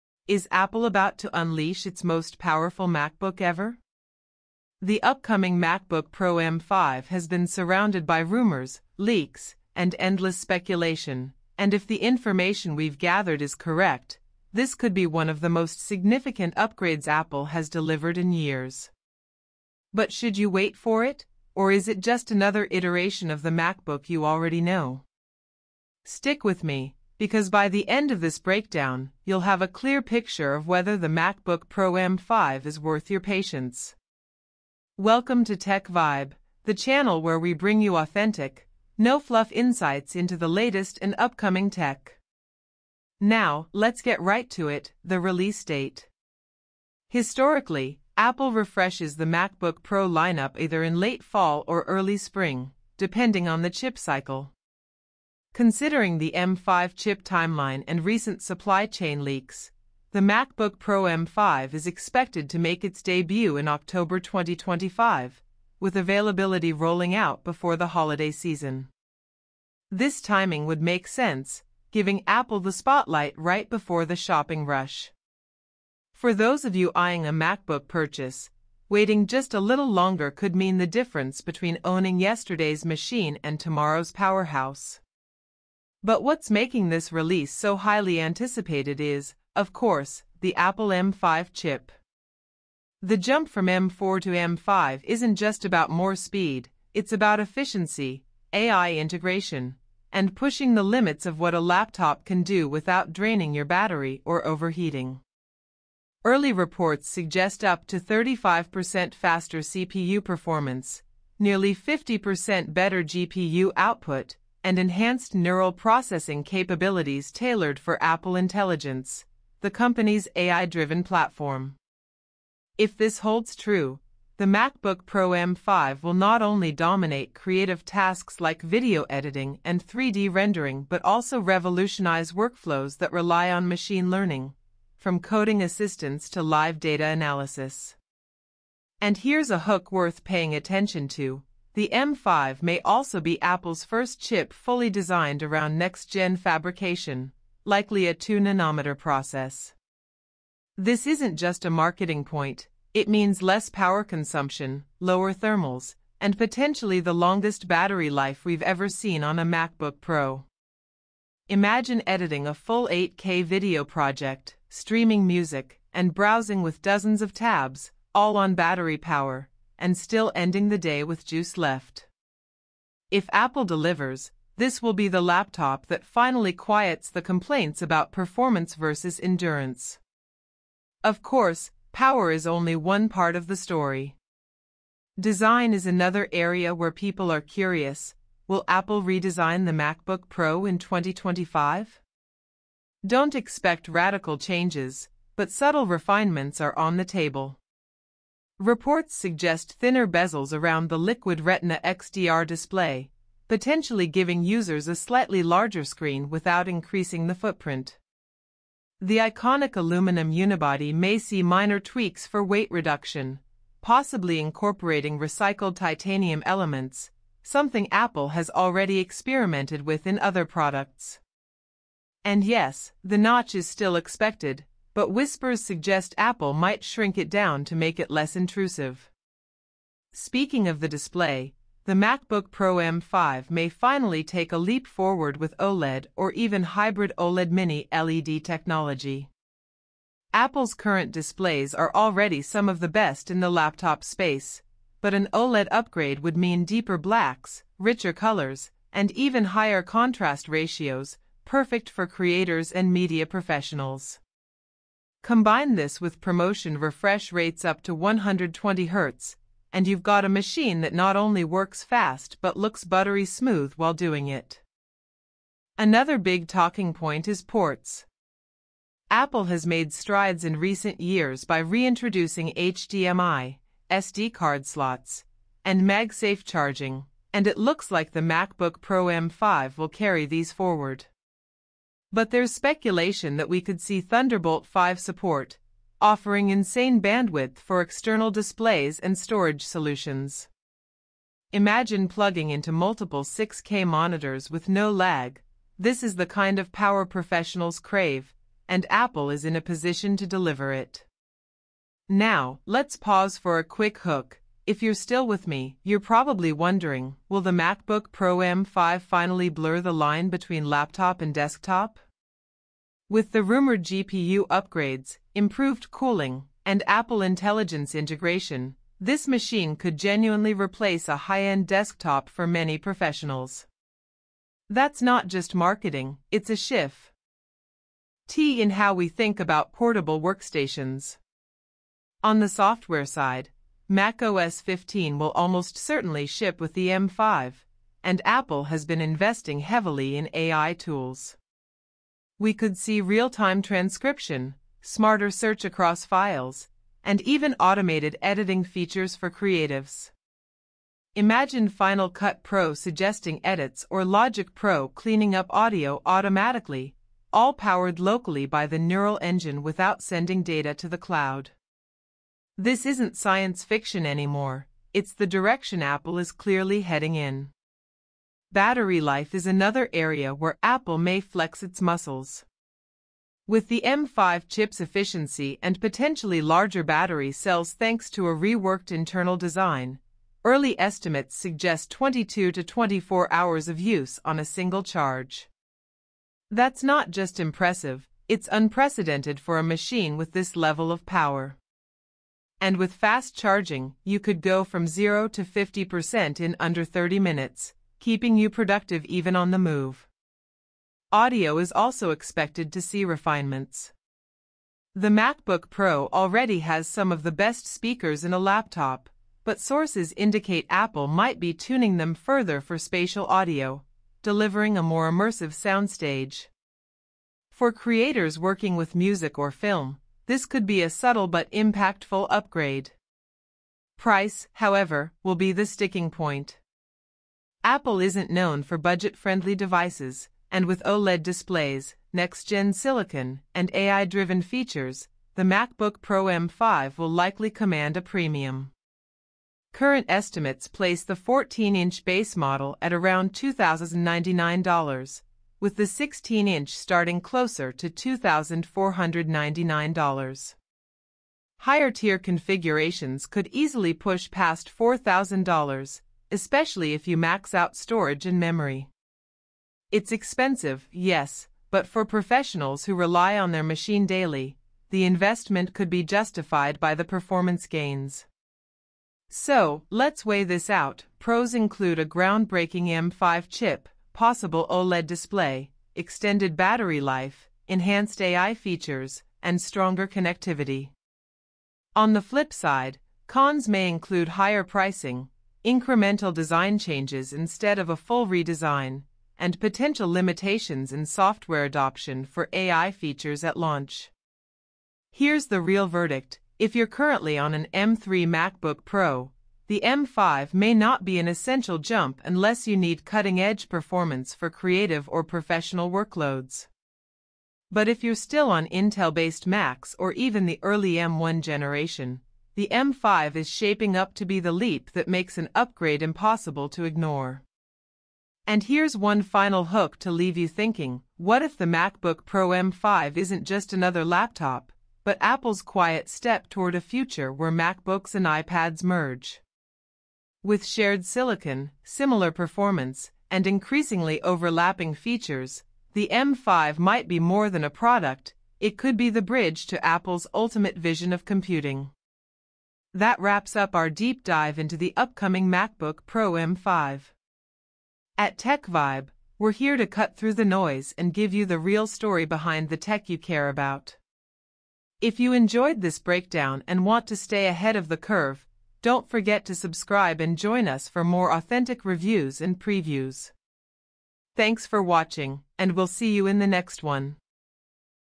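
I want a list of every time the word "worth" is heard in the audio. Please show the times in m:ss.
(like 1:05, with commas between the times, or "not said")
0:32, 2:19.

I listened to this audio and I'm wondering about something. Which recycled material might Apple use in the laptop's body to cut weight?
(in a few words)
titanium.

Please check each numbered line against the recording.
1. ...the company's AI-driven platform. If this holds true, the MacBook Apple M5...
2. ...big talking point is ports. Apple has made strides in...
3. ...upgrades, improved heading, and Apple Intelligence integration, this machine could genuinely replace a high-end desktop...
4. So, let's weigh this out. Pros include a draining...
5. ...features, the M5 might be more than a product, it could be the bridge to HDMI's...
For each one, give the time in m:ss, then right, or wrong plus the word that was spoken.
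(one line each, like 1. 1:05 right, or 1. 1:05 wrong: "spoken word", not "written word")
1. 1:59 wrong: "Pro", not "Apple"
2. 4:26 right
3. 5:14 wrong: "cooling", not "heading"
4. 7:49 wrong: "groundbreaking", not "draining"
5. 8:54 wrong: "Apple", not "HDMI".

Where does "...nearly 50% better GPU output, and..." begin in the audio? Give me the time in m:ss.
1:51.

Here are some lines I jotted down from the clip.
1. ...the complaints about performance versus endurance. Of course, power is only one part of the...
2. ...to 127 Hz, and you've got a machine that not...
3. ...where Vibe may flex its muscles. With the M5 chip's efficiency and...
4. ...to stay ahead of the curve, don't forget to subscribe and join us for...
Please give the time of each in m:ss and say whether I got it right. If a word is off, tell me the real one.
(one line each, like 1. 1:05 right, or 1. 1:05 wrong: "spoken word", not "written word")
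1. 2:57 right
2. 4:17 wrong: "120", not "127"
3. 6:10 wrong: "Apple", not "Vibe"
4. 9:17 right.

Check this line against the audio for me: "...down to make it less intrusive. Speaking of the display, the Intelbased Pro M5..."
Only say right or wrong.
wrong.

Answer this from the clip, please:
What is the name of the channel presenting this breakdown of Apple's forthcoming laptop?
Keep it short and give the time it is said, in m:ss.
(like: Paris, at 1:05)
Tech Vibe, at 0:35.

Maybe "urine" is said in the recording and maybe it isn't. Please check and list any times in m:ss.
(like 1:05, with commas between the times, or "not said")
not said.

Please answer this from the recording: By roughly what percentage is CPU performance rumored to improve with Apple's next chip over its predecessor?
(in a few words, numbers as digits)
35%.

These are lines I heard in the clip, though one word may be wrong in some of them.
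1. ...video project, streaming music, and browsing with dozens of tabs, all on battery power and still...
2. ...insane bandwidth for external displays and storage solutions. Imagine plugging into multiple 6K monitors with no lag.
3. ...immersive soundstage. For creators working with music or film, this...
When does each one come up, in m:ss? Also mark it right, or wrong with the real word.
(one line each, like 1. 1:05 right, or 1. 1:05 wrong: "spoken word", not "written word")
1. 2:43 right
2. 4:46 right
3. 6:55 right.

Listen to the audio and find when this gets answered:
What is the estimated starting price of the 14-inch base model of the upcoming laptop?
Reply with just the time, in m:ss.
7:23.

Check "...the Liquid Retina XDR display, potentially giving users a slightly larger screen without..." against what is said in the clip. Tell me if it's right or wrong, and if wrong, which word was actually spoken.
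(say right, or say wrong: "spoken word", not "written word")
right.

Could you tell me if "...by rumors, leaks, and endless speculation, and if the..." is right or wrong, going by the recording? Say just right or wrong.
right.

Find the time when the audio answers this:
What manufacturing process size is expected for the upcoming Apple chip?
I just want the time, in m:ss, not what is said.
2:28.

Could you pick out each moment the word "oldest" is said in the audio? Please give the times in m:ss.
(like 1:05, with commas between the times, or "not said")
not said.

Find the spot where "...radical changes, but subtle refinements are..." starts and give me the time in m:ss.
3:13.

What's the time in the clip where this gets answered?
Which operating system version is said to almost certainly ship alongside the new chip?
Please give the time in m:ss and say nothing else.
5:33.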